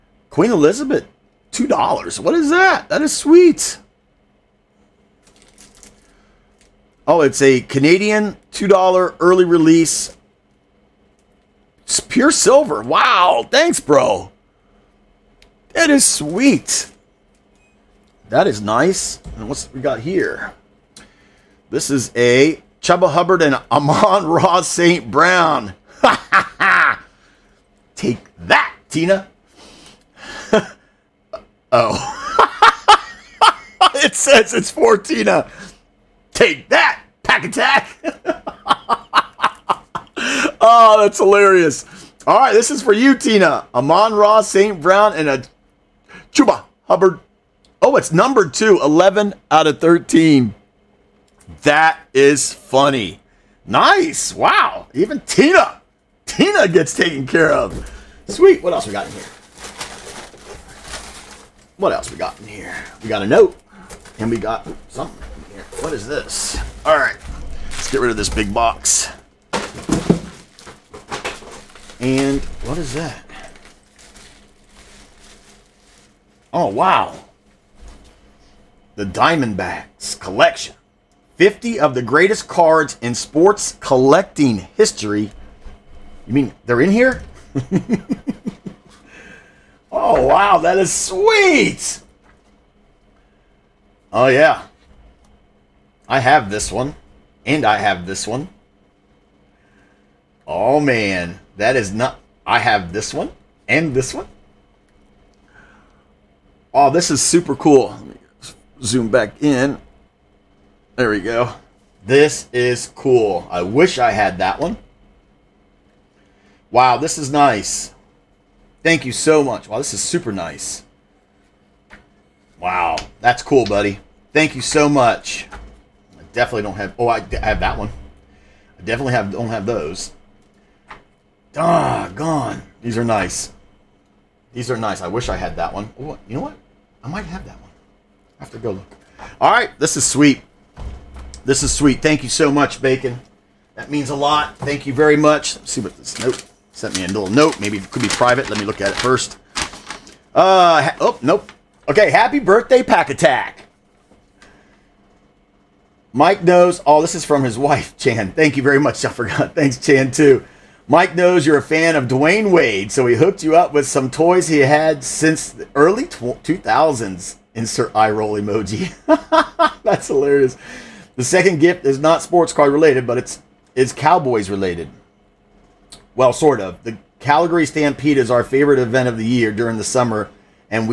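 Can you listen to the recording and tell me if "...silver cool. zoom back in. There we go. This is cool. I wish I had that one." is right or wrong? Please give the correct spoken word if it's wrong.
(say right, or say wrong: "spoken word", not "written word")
wrong: "super", not "silver".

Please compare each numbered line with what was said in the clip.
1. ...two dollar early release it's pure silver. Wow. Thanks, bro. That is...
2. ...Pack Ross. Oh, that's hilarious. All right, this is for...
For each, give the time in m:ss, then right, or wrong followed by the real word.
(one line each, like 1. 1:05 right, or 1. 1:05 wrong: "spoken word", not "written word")
1. 0:08 right
2. 0:37 wrong: "Attack", not "Ross".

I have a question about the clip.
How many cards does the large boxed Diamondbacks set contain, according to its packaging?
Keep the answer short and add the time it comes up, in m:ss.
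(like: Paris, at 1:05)
50, at 1:21.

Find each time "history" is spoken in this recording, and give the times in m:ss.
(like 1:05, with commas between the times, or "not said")
1:24.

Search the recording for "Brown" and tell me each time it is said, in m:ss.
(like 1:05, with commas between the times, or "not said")
0:25, 0:44.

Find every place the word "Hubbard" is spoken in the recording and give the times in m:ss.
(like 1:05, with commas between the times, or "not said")
0:23, 0:46.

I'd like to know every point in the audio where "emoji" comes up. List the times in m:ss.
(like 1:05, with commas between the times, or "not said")
2:48.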